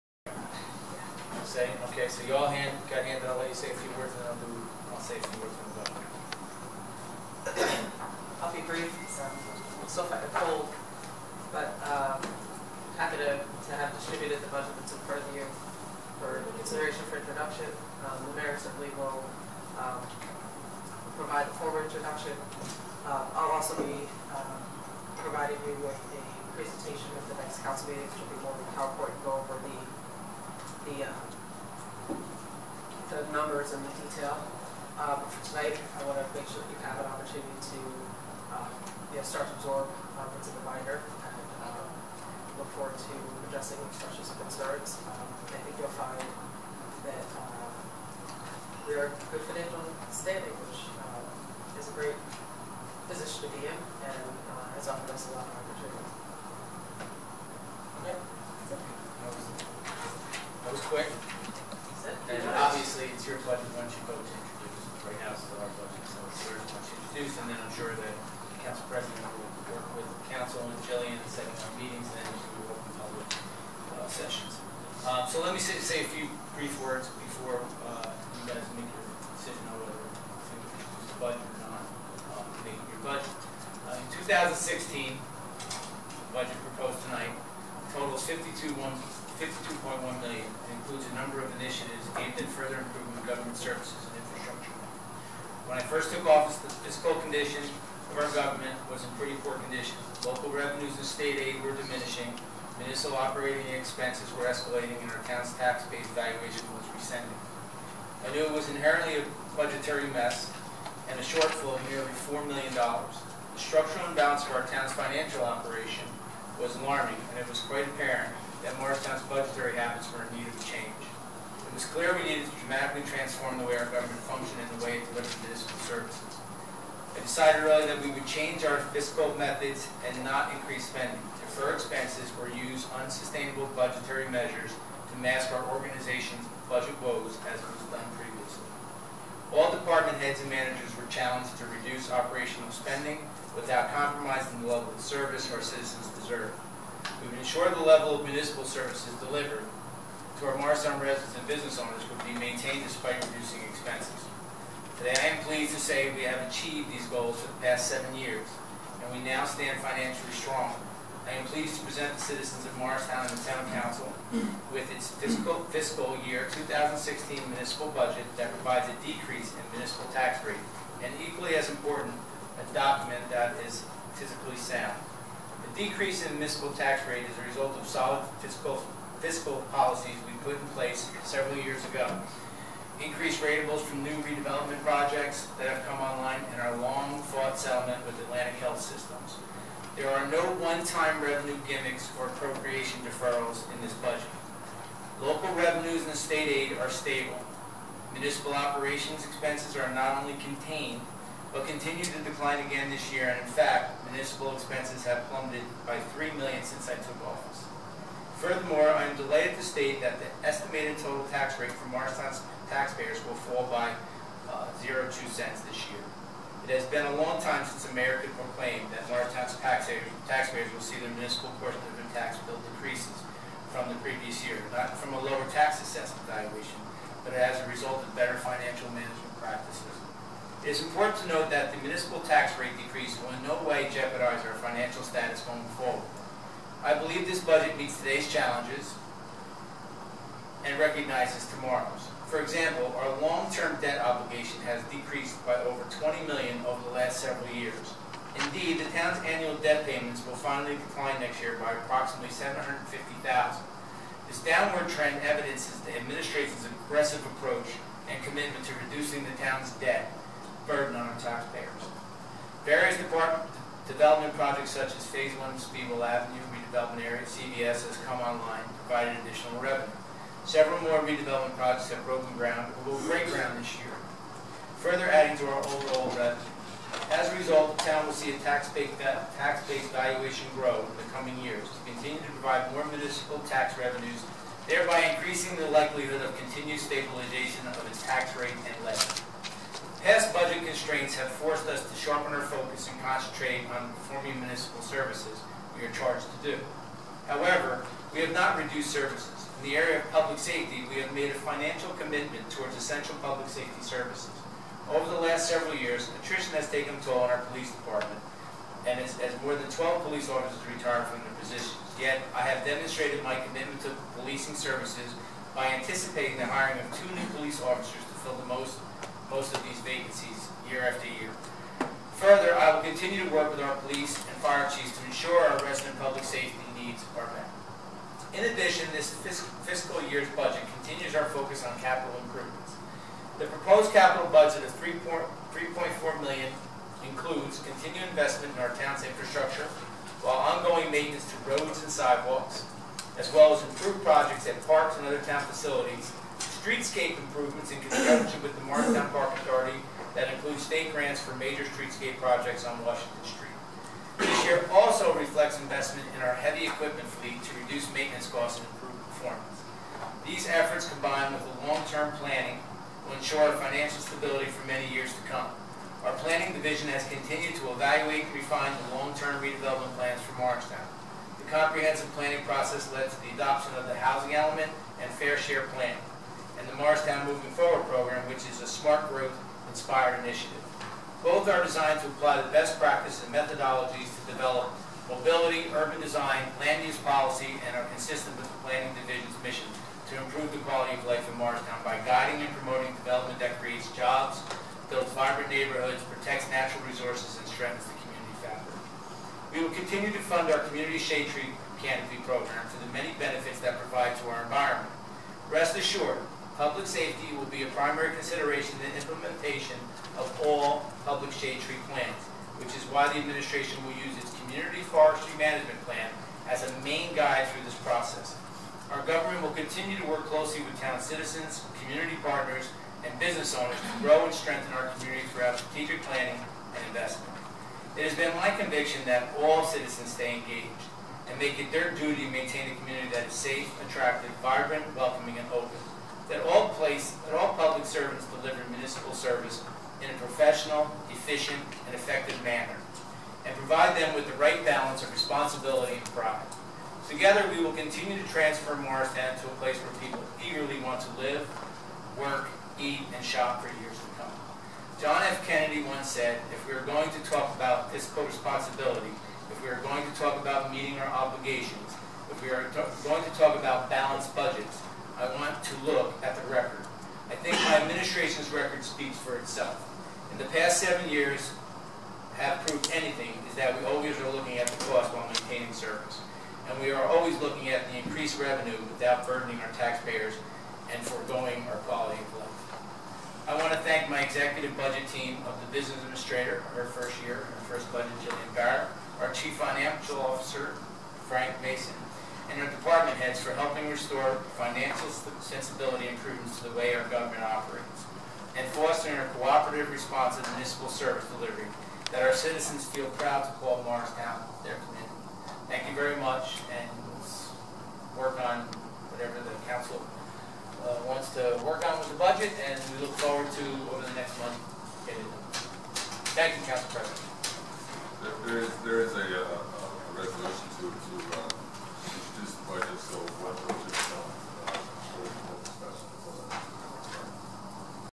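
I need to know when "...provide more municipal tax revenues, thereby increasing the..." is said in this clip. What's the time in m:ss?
4:42.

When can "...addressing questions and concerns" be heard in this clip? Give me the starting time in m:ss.
0:43.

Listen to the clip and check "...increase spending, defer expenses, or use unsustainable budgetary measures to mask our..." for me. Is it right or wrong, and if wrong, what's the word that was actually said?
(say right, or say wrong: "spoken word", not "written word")
right.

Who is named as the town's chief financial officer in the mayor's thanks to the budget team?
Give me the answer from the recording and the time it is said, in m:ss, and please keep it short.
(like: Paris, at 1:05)
Frank Mason, at 8:11.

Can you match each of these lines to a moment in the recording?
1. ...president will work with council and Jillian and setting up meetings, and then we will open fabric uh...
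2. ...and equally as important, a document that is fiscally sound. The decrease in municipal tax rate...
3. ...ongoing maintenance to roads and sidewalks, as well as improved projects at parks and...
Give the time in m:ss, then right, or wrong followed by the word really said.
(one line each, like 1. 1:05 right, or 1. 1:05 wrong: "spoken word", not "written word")
1. 1:08 wrong: "public", not "fabric"
2. 2:51 right
3. 5:40 right.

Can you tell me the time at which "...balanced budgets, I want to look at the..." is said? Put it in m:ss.
7:43.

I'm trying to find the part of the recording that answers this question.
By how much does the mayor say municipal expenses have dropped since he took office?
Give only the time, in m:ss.
3:26.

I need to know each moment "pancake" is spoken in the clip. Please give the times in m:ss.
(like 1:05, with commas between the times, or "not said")
not said.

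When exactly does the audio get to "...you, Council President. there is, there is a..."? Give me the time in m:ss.
8:36.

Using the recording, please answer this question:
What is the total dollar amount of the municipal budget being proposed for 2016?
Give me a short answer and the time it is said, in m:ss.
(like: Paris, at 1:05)
$52.1 million, at 1:29.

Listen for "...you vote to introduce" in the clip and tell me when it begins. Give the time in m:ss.
1:03.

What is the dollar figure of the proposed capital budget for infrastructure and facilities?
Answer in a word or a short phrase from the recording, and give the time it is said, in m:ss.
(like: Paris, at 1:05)
$3.4 million, at 5:34.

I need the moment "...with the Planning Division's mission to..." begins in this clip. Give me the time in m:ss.
6:28.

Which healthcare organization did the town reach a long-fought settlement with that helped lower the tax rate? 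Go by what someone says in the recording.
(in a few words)
Atlantic Health Systems.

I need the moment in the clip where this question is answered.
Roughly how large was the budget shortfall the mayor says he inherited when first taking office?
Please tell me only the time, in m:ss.
1:51.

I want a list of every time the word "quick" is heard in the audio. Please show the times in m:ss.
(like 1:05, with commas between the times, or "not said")
1:00.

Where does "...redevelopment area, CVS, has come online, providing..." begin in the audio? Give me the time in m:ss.
4:26.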